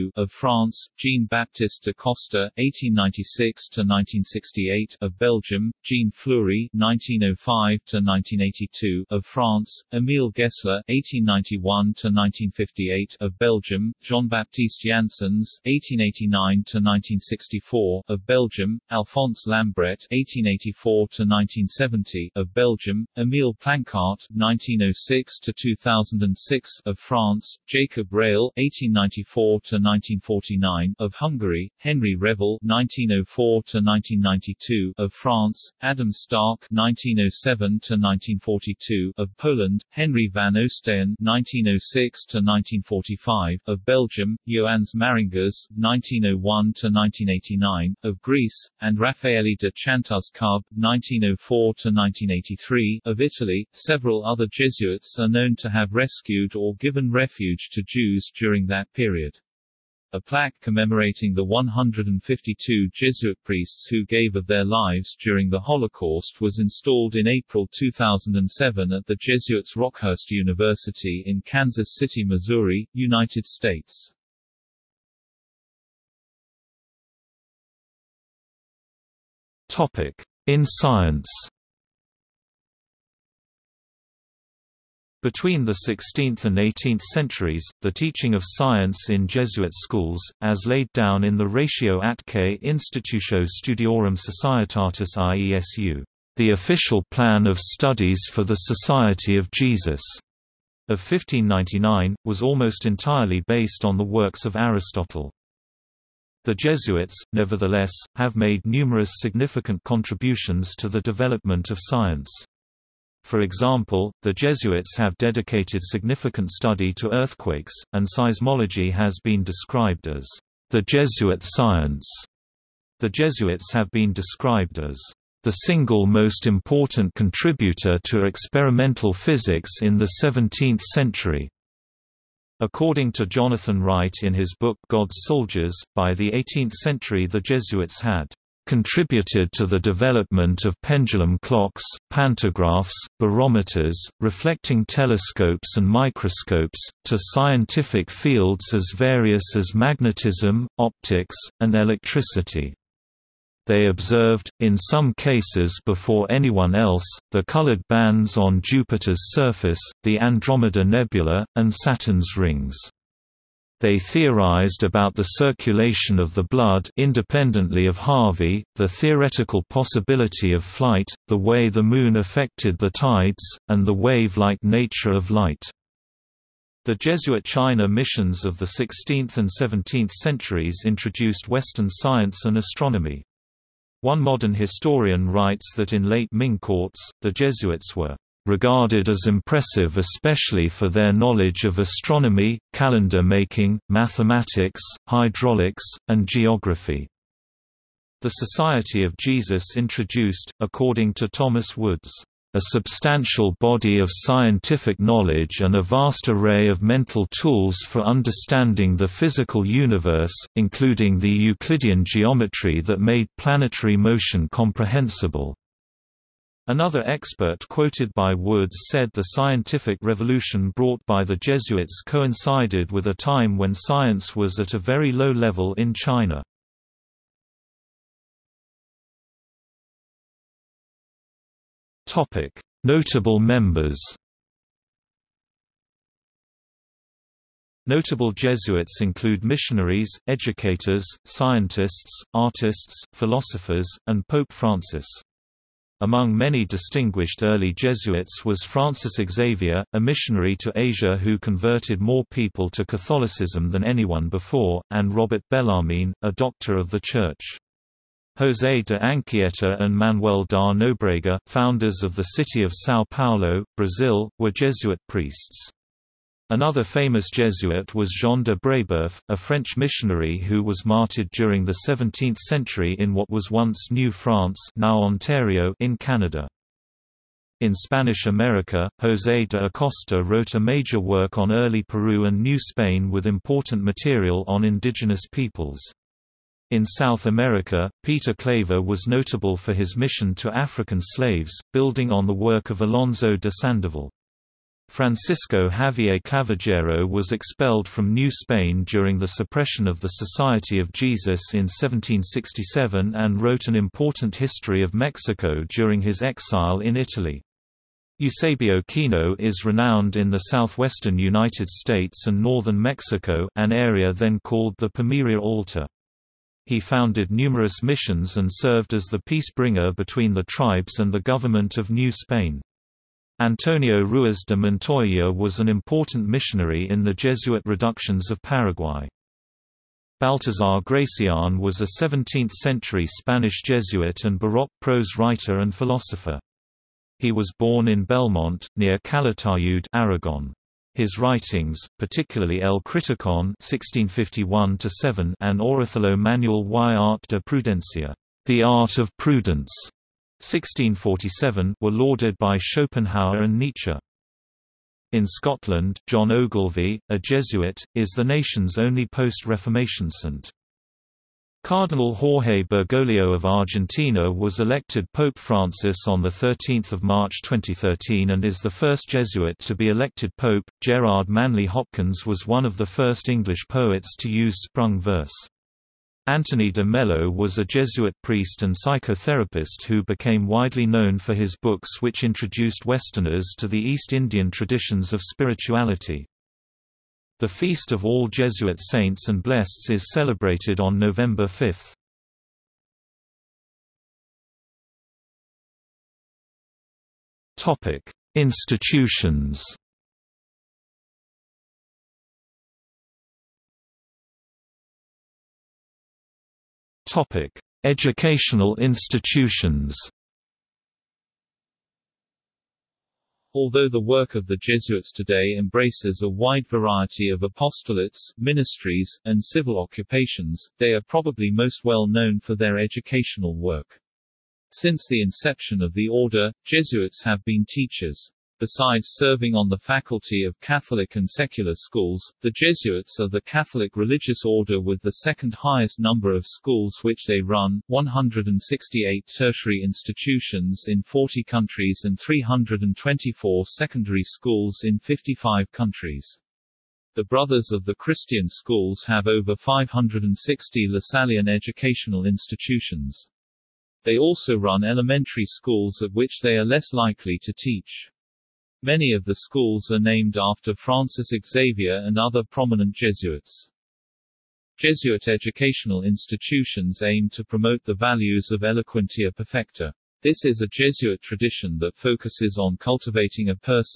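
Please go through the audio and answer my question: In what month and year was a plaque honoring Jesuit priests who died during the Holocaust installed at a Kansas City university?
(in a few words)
April 2007.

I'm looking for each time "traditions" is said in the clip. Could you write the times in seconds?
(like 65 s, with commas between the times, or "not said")
384 s, 471 s.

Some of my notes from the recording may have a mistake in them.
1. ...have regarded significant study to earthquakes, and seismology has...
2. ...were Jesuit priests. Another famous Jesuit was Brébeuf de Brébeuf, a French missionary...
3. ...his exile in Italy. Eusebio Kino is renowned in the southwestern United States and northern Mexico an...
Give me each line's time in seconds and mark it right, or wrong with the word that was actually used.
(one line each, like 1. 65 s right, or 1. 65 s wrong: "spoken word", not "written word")
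1. 114 s wrong: "dedicated", not "regarded"
2. 264 s wrong: "Jean", not "Brébeuf"
3. 306 s right.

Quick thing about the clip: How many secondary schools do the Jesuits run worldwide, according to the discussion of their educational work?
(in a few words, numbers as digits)
324.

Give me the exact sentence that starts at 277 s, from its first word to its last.
In Spanish America, José de Acosta wrote a major work on early Peru and New Spain with important material on indigenous peoples.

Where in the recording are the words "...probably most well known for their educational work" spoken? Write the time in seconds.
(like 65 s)
421 s.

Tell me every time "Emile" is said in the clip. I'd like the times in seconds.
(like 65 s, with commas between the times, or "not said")
9 s, 23 s.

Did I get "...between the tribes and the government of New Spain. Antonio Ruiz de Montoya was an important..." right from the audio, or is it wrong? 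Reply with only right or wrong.
right.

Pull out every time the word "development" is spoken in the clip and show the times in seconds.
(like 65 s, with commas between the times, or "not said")
111 s, 139 s.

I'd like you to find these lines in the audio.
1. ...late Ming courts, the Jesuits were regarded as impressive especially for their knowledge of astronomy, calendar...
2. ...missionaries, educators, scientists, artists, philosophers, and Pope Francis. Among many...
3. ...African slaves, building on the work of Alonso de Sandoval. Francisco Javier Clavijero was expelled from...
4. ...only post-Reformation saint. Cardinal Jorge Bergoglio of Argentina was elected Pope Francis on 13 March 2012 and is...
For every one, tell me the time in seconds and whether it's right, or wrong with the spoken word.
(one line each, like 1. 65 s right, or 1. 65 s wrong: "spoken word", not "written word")
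1. 186 s right
2. 239 s right
3. 290 s right
4. 358 s wrong: "2013", not "2012".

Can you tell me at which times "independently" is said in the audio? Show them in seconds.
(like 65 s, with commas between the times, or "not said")
166 s.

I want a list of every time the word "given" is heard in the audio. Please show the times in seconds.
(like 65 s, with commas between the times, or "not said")
56 s.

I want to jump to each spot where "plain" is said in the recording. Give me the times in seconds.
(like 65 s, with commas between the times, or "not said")
not said.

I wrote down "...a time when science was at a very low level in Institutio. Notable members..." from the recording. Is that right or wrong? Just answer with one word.
wrong.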